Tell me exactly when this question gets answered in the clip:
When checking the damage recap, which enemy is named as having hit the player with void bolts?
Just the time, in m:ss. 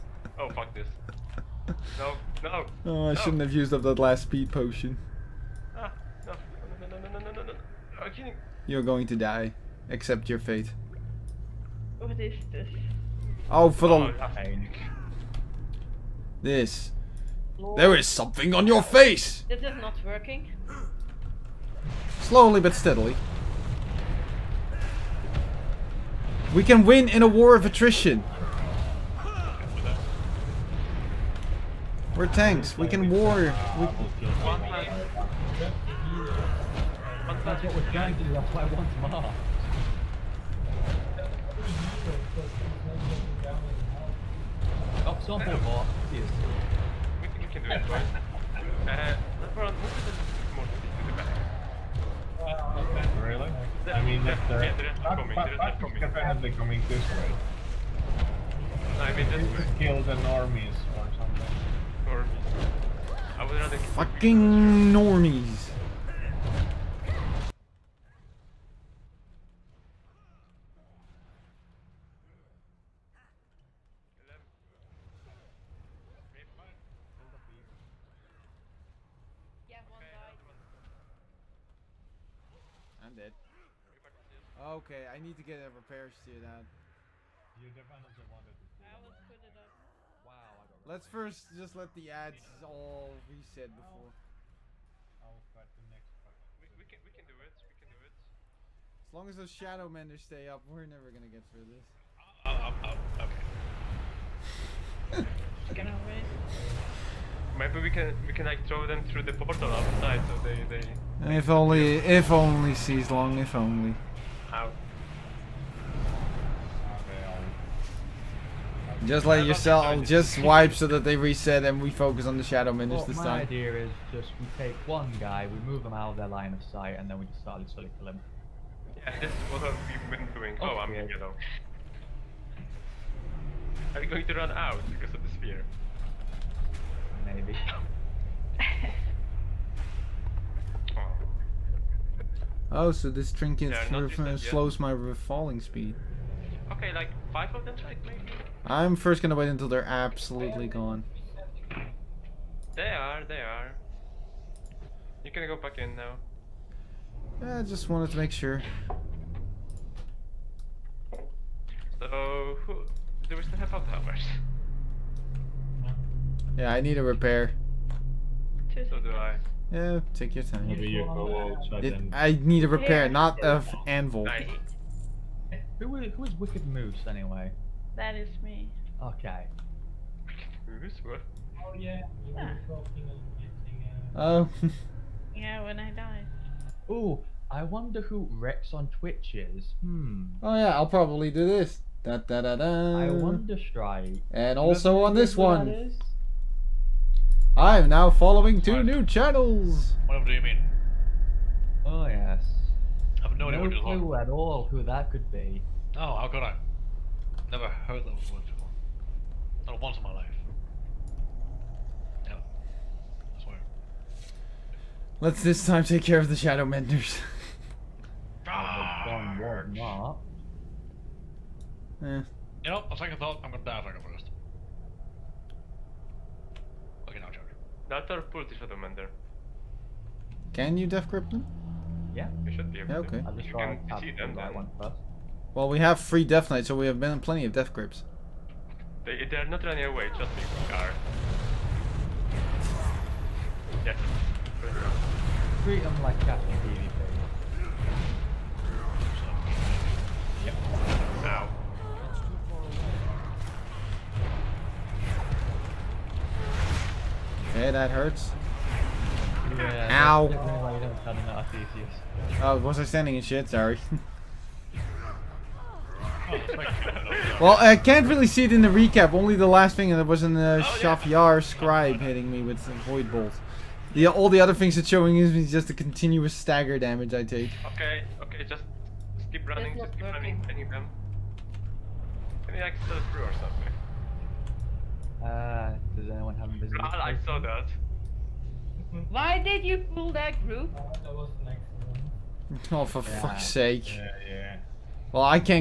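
4:30.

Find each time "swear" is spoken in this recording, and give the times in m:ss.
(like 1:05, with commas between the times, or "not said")
3:33.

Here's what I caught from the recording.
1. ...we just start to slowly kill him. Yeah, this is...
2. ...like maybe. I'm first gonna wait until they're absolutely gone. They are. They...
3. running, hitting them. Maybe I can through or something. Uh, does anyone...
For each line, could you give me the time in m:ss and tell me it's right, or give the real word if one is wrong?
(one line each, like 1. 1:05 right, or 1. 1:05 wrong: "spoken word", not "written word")
1. 2:07 right
2. 2:27 right
3. 4:40 wrong: "running", not "hitting".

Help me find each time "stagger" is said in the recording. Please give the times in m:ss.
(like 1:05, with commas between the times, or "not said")
4:36.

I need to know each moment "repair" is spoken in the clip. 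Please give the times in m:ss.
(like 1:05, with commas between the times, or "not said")
1:25, 2:47, 2:52.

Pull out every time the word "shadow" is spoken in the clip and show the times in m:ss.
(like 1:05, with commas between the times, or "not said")
1:39, 2:02, 3:36.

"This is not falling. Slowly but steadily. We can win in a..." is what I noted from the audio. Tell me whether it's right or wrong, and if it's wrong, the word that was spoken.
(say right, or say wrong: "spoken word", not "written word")
wrong: "working", not "falling".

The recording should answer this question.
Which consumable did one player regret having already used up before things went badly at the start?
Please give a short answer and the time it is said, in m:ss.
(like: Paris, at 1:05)
speed potion, at 0:04.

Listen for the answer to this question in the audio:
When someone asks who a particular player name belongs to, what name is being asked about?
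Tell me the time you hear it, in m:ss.
2:56.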